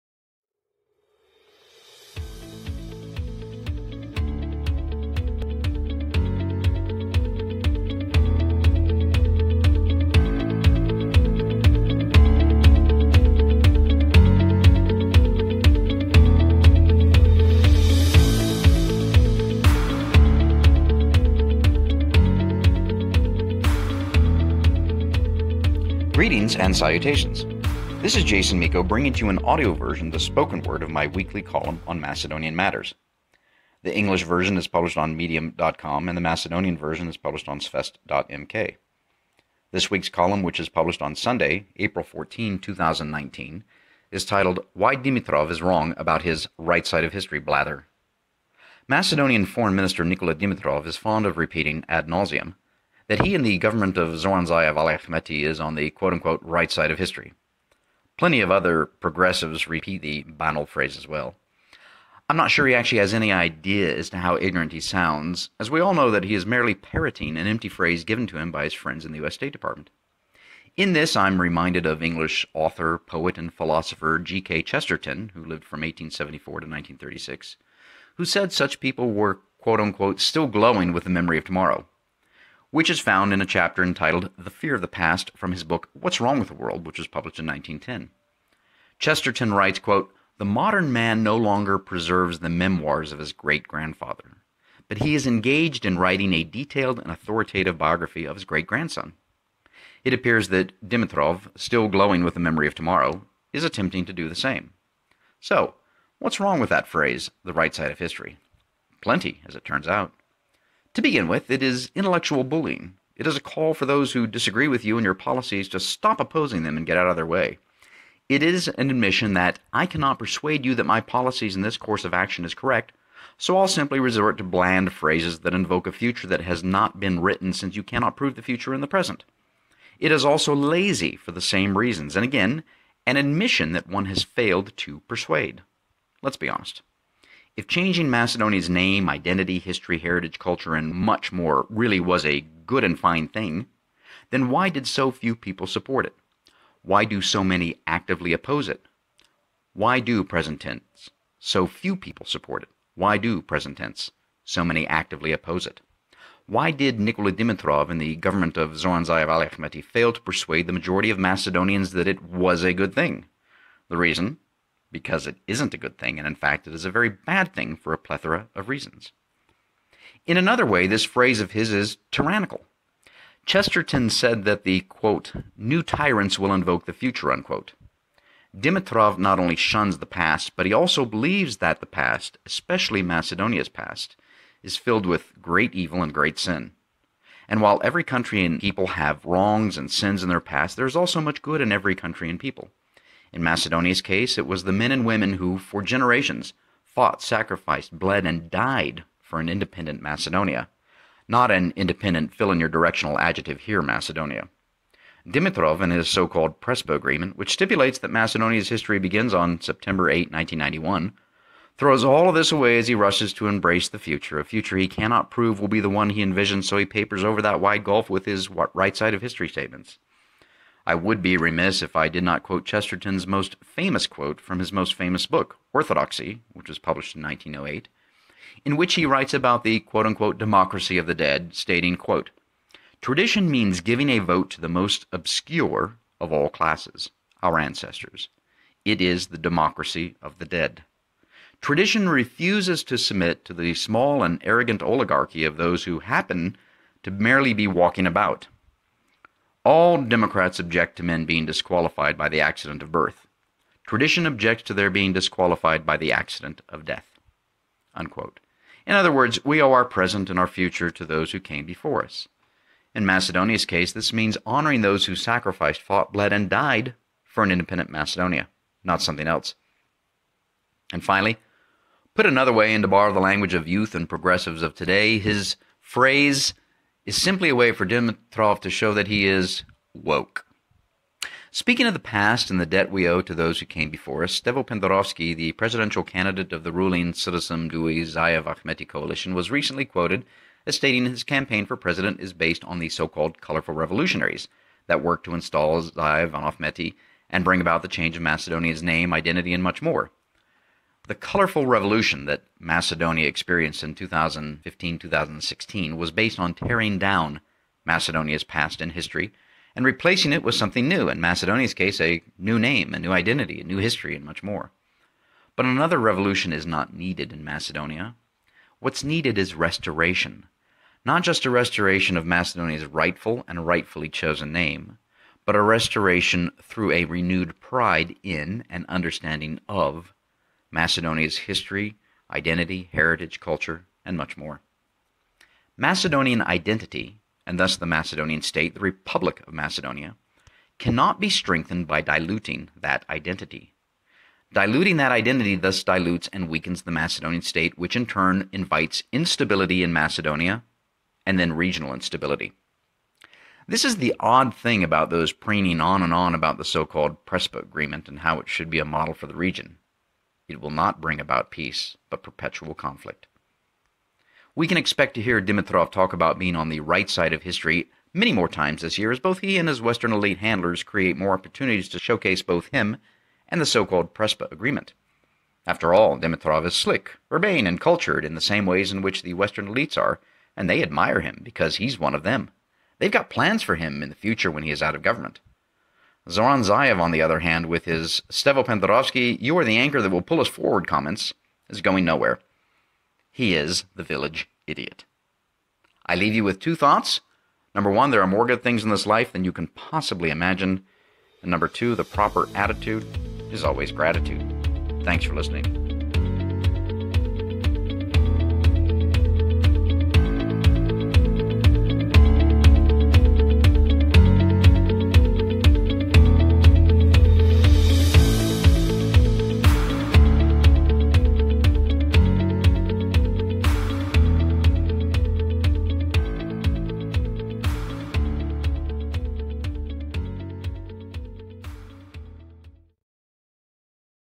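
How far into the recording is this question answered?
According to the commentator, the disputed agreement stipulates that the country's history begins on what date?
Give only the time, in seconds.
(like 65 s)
209 s.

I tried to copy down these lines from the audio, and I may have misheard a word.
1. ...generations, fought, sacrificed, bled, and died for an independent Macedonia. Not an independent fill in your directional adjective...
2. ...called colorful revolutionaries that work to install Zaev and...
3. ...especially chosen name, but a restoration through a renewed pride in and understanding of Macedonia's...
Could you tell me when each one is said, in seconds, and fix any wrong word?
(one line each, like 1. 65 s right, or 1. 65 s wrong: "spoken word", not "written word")
1. 195 s right
2. 293 s right
3. 323 s wrong: "rightfully", not "especially".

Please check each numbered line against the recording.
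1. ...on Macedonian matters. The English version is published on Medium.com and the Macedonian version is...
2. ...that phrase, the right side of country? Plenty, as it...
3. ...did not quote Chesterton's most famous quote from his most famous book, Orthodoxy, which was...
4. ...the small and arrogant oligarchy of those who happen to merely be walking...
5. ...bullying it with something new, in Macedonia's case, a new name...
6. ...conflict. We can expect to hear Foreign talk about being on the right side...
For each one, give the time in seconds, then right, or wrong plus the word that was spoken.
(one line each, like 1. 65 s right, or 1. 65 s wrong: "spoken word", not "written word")
1. 31 s right
2. 106 s wrong: "history", not "country"
3. 222 s right
4. 243 s right
5. 309 s wrong: "replacing", not "bullying"
6. 362 s wrong: "Dimitrov", not "Foreign".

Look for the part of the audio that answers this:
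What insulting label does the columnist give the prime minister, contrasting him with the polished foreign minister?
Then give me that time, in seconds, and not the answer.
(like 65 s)
394 s.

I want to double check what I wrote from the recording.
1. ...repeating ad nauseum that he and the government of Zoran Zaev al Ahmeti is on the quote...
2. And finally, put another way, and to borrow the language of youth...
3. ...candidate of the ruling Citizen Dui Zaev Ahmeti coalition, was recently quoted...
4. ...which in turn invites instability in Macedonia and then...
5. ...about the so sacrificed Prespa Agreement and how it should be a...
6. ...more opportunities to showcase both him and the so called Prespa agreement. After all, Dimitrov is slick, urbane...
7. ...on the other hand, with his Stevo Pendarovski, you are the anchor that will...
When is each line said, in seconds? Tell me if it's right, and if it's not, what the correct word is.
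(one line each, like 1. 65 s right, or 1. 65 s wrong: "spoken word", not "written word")
1. 51 s right
2. 270 s right
3. 286 s right
4. 347 s right
5. 356 s wrong: "called", not "sacrificed"
6. 371 s right
7. 386 s right.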